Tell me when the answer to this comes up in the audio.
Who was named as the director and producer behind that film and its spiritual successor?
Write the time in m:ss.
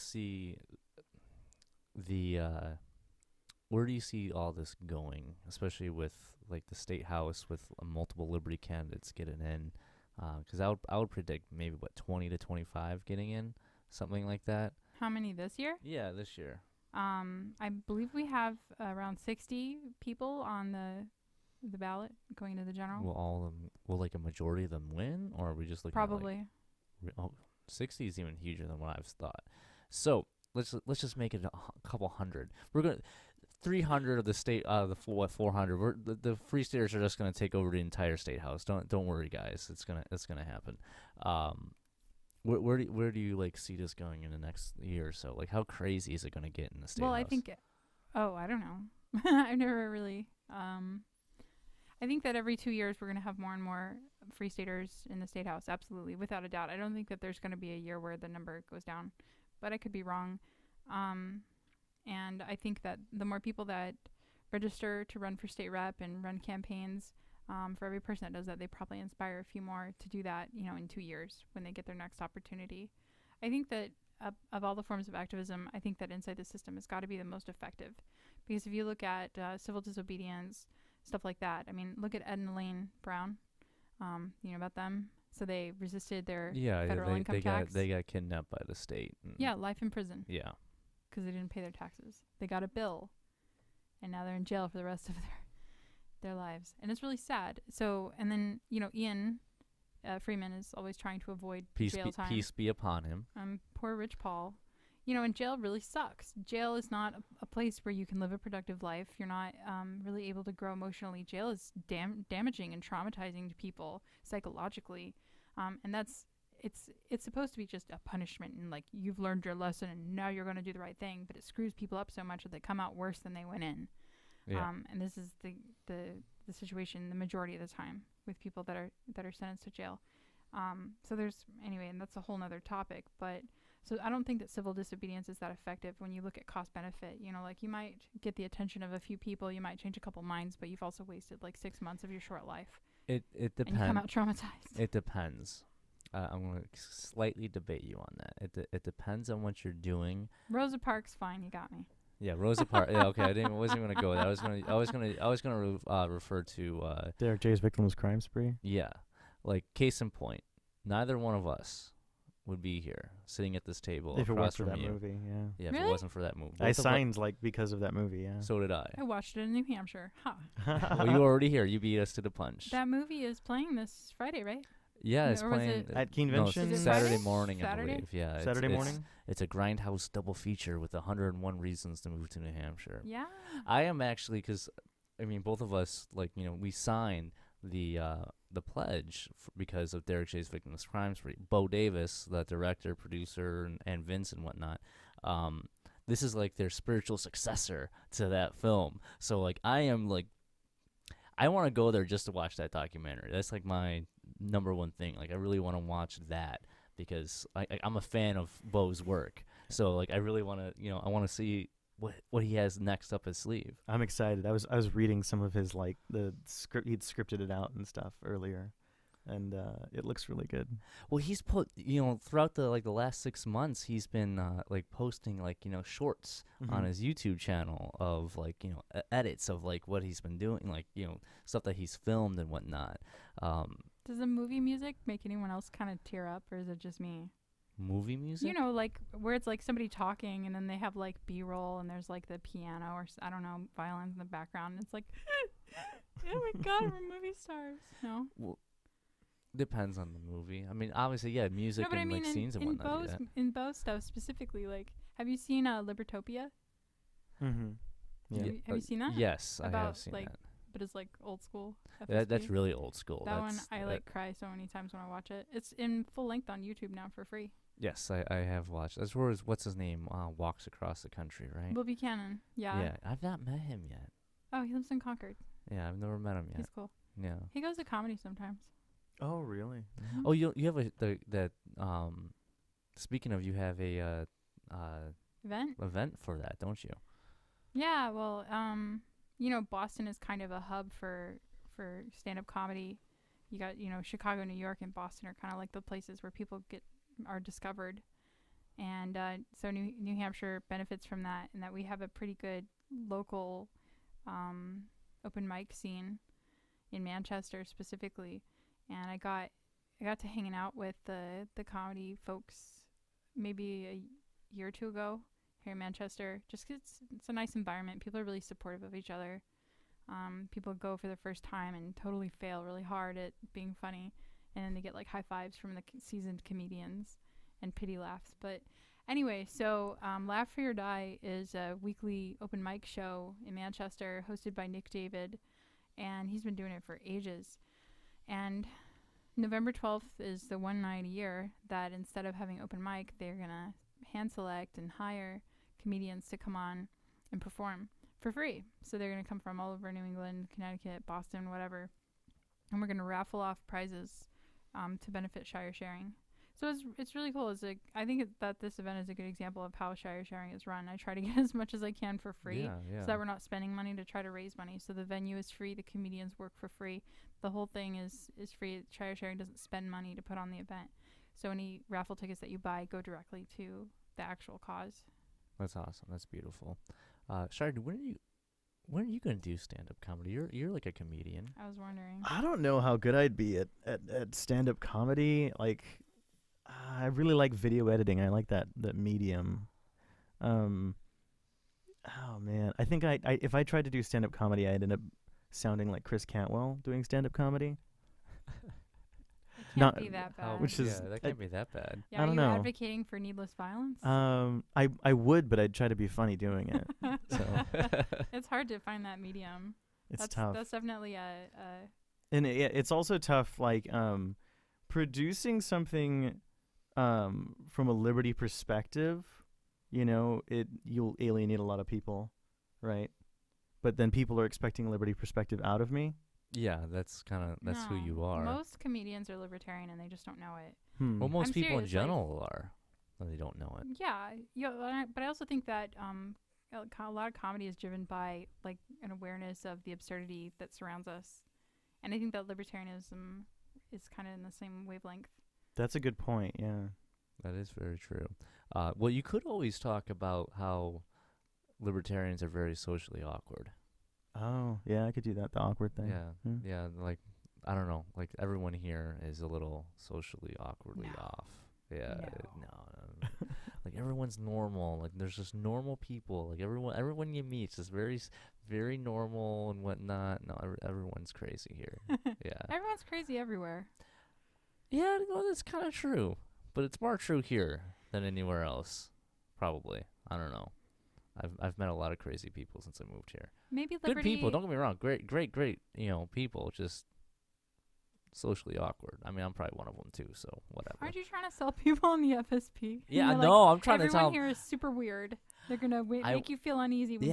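3:11.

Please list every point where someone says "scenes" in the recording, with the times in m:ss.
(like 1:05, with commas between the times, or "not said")
4:12, 5:05.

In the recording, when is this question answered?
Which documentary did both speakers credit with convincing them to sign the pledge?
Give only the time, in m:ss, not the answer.
2:37.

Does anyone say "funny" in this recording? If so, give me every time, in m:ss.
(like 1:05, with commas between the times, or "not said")
5:23, 6:46.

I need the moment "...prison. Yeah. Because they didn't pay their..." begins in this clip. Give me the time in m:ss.
1:29.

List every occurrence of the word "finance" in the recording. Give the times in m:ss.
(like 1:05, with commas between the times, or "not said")
not said.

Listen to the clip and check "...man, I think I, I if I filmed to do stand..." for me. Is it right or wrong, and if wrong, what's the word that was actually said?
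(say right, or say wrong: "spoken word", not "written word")
wrong: "tried", not "filmed".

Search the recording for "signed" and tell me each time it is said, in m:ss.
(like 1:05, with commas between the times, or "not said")
2:46, 3:06.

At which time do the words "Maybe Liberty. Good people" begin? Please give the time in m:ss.
8:03.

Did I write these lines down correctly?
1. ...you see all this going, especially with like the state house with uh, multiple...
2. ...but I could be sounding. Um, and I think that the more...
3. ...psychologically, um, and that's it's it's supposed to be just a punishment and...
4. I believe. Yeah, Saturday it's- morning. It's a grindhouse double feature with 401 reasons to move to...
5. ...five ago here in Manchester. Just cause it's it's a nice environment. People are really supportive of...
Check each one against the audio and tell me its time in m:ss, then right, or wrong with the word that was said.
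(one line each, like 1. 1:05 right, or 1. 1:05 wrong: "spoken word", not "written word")
1. 0:03 right
2. 0:59 wrong: "wrong", not "sounding"
3. 1:54 right
4. 2:57 wrong: "101", not "401"
5. 5:14 wrong: "two", not "five".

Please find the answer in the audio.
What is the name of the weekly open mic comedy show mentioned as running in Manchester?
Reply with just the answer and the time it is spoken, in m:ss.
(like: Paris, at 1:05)
Laugh Free or Die, at 5:30.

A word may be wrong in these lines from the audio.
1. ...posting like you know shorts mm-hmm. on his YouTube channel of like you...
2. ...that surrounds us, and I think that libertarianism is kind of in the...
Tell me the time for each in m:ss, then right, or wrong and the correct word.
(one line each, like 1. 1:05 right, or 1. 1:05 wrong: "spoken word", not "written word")
1. 3:44 right
2. 7:20 right.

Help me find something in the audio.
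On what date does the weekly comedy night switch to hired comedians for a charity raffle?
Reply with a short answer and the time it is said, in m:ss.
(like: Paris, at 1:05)
November 12, at 5:39.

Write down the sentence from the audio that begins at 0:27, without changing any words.
At like, oh, 60 is even huger than what I've thought.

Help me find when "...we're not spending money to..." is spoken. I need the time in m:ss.
6:03.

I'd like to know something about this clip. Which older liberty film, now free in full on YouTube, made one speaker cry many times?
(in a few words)
Libertopia.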